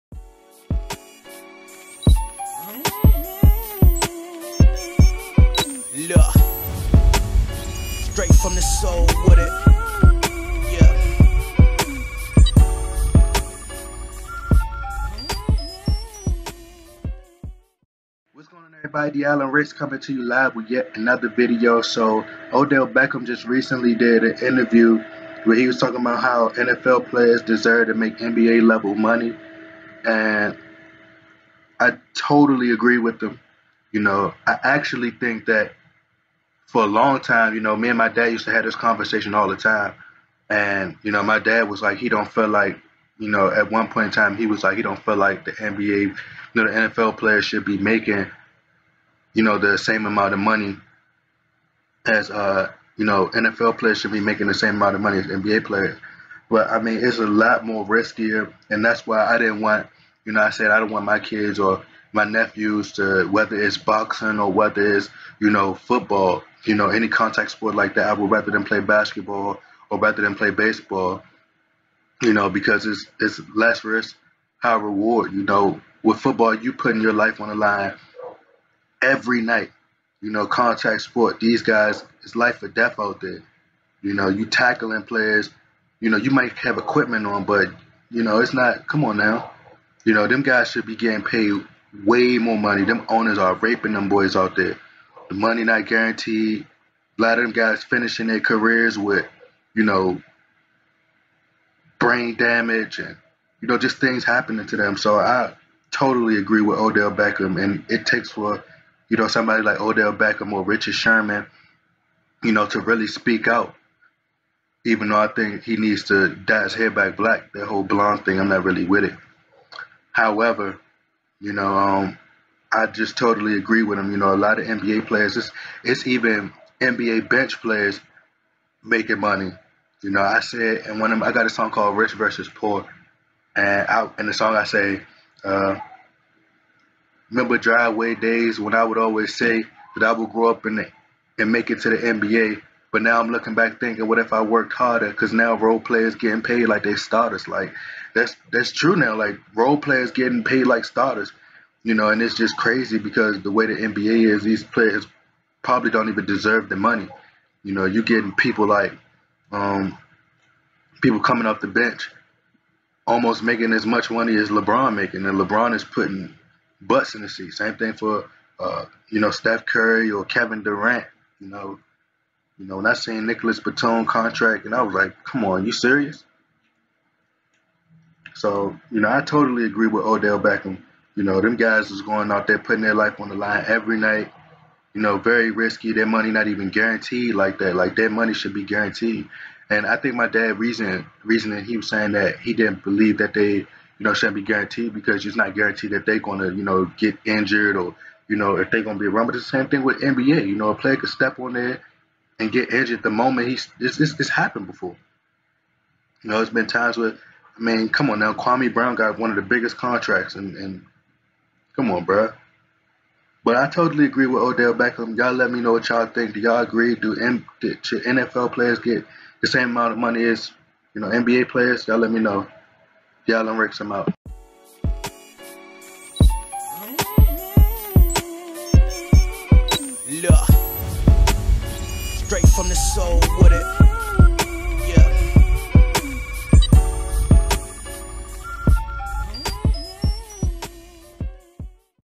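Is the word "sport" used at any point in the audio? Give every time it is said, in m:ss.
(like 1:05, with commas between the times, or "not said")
1:07, 1:21.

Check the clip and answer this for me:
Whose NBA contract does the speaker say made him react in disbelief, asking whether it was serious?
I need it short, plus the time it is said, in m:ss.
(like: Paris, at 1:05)
Nicolas Batum, at 2:53.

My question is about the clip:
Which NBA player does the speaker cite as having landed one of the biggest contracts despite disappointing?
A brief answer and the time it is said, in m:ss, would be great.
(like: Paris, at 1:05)
Kwame Brown, at 3:28.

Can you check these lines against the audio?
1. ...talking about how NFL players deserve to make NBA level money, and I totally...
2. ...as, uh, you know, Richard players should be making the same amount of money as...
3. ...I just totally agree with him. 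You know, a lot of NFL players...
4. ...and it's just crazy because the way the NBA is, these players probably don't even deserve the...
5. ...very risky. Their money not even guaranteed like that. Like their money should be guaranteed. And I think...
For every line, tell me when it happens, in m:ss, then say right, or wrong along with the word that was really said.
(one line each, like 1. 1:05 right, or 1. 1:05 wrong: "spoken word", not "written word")
1. 0:25 right
2. 0:52 wrong: "NFL", not "Richard"
3. 2:02 wrong: "NBA", not "NFL"
4. 2:32 right
5. 3:05 right.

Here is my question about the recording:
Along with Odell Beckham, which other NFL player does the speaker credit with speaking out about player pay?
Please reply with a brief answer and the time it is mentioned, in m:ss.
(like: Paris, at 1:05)
Richard Sherman, at 1:50.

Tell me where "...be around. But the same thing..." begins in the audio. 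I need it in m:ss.
3:18.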